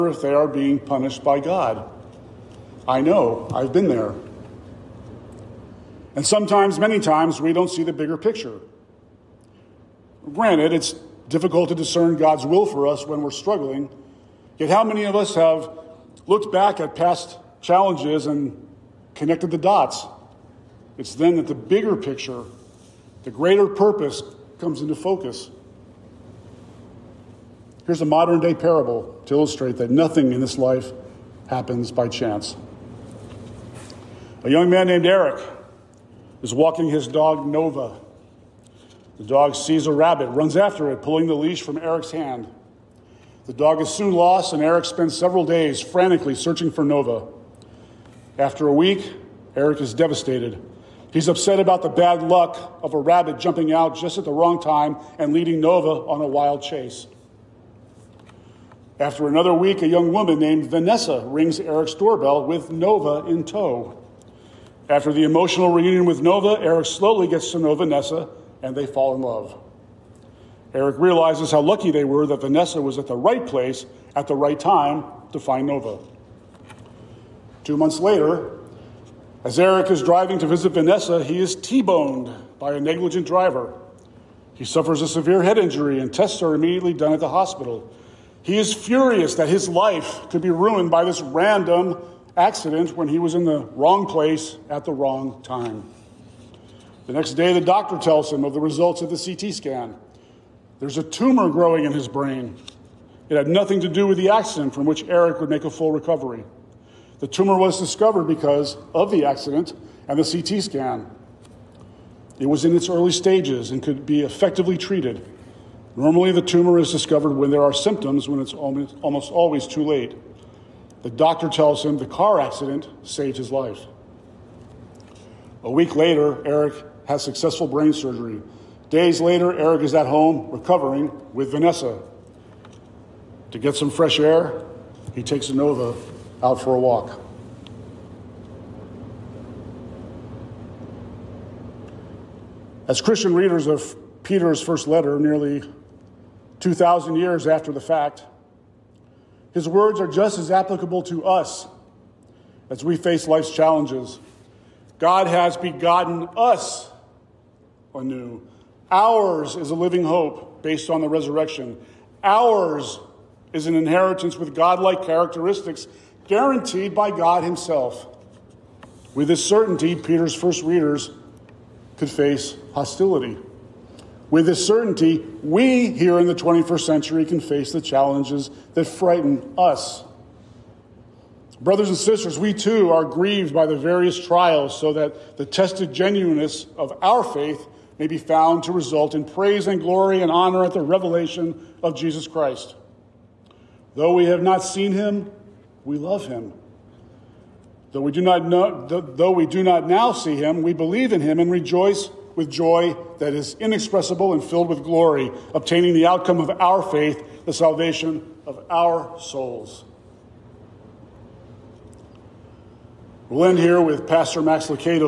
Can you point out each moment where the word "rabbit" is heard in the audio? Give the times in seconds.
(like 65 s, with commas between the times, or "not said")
39 s, 52 s.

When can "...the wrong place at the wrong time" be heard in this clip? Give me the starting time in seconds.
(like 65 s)
93 s.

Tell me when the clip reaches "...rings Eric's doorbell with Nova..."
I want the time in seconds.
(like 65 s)
61 s.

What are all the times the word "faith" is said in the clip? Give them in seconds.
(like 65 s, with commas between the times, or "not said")
187 s, 206 s.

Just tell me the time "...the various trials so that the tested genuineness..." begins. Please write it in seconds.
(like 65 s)
183 s.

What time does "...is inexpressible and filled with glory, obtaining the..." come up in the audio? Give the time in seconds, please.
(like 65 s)
203 s.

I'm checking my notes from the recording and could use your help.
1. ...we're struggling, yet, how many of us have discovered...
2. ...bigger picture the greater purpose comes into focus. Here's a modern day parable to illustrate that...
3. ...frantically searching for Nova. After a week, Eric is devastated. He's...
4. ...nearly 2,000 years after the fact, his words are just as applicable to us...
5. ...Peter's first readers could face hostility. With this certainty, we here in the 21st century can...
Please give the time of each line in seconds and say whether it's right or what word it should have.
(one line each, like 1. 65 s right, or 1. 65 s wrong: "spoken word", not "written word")
1. 13 s wrong: "looked", not "discovered"
2. 21 s right
3. 45 s right
4. 145 s right
5. 169 s right.